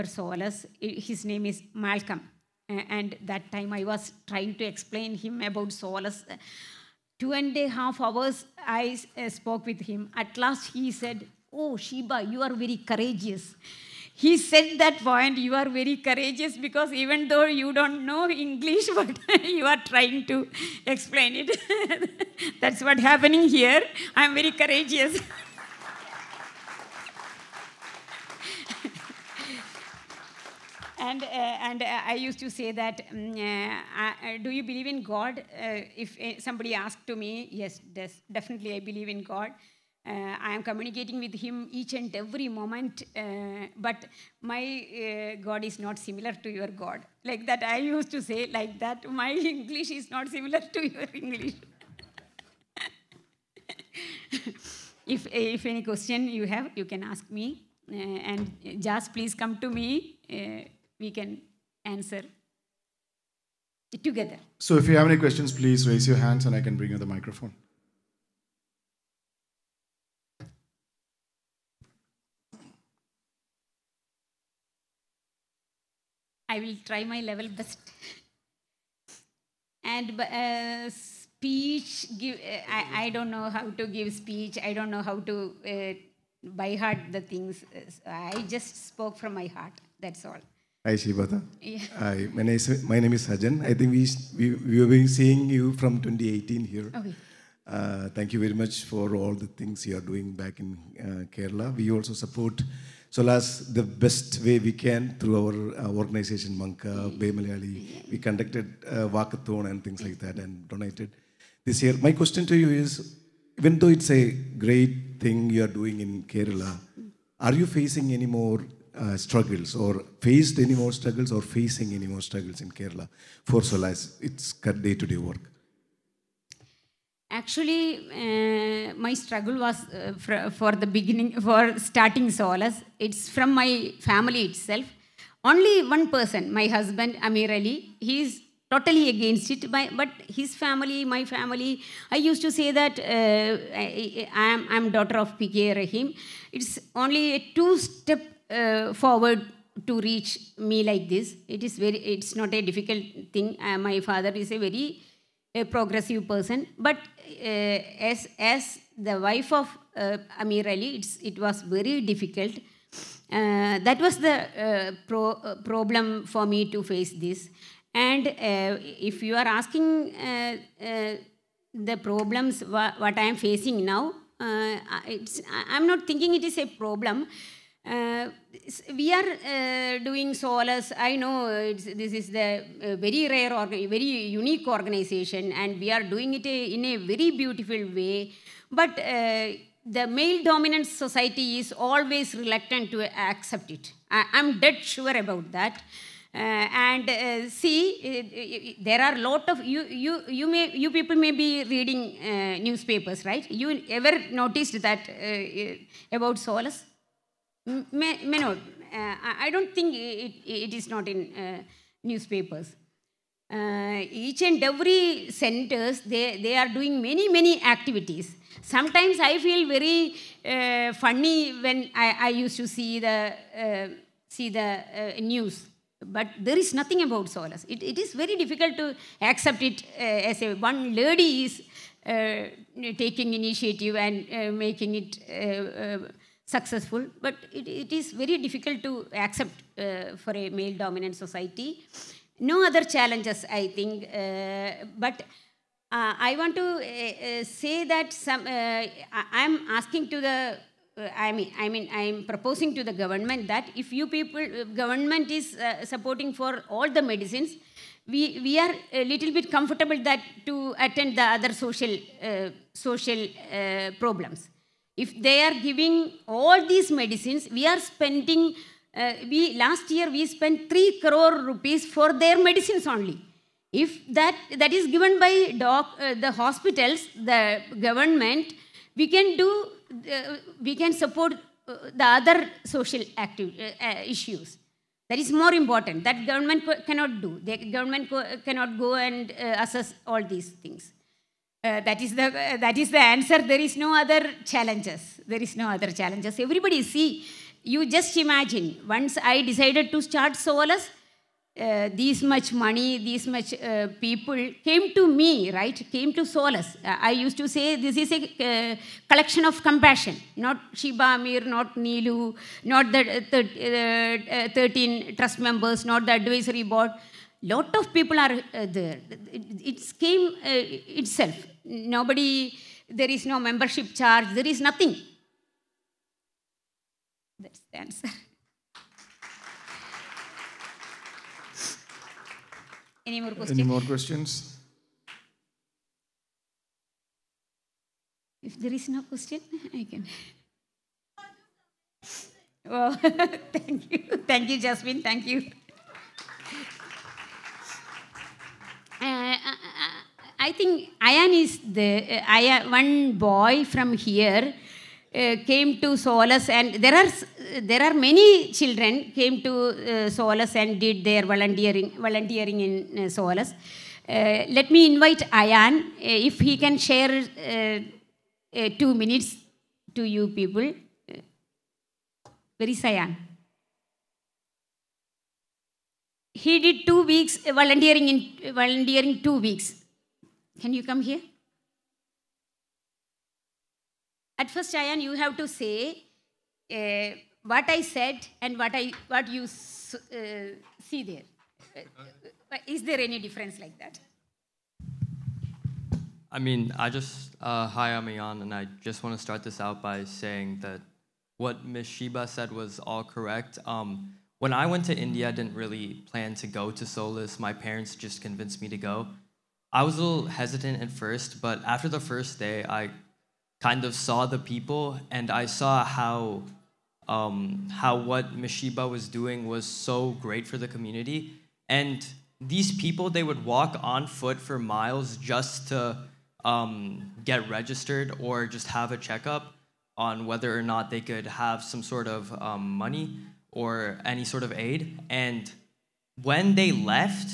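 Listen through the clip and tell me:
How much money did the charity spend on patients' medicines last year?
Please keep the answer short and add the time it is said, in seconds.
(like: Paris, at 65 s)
3 crore rupees, at 270 s.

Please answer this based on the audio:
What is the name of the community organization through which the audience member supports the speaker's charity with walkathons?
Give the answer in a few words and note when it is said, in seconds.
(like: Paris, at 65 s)
MANCA, at 106 s.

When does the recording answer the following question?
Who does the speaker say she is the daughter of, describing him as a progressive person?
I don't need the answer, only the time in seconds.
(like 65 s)
145 s.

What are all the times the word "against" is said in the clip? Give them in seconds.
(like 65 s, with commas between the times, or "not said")
139 s.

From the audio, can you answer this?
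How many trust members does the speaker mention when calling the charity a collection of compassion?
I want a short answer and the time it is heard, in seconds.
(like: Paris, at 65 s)
13, at 314 s.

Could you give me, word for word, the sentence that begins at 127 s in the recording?
Actually, uh, my struggle was uh, for, for, the beginning, for starting Solace.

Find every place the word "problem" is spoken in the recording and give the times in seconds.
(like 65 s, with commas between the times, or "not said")
165 s, 172 s, 176 s, 263 s.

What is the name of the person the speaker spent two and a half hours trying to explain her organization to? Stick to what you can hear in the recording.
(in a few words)
Malcolm.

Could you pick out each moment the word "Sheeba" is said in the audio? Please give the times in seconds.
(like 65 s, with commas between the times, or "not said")
11 s, 310 s, 401 s.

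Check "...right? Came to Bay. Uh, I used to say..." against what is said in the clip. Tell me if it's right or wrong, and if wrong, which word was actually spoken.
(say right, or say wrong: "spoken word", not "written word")
wrong: "Solace", not "Bay".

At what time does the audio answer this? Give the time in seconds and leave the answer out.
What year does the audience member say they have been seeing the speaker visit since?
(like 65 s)
96 s.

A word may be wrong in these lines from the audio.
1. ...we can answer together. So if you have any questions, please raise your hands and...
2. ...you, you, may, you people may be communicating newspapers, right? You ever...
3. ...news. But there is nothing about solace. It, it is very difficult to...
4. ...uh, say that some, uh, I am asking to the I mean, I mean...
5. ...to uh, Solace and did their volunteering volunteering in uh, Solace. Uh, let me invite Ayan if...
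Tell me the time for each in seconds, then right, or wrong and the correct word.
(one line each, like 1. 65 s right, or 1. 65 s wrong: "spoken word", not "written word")
1. 61 s right
2. 200 s wrong: "reading", not "communicating"
3. 225 s right
4. 247 s right
5. 359 s right.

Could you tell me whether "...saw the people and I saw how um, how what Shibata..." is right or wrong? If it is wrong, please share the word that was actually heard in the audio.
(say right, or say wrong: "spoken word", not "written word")
wrong: "Mishiba", not "Shibata".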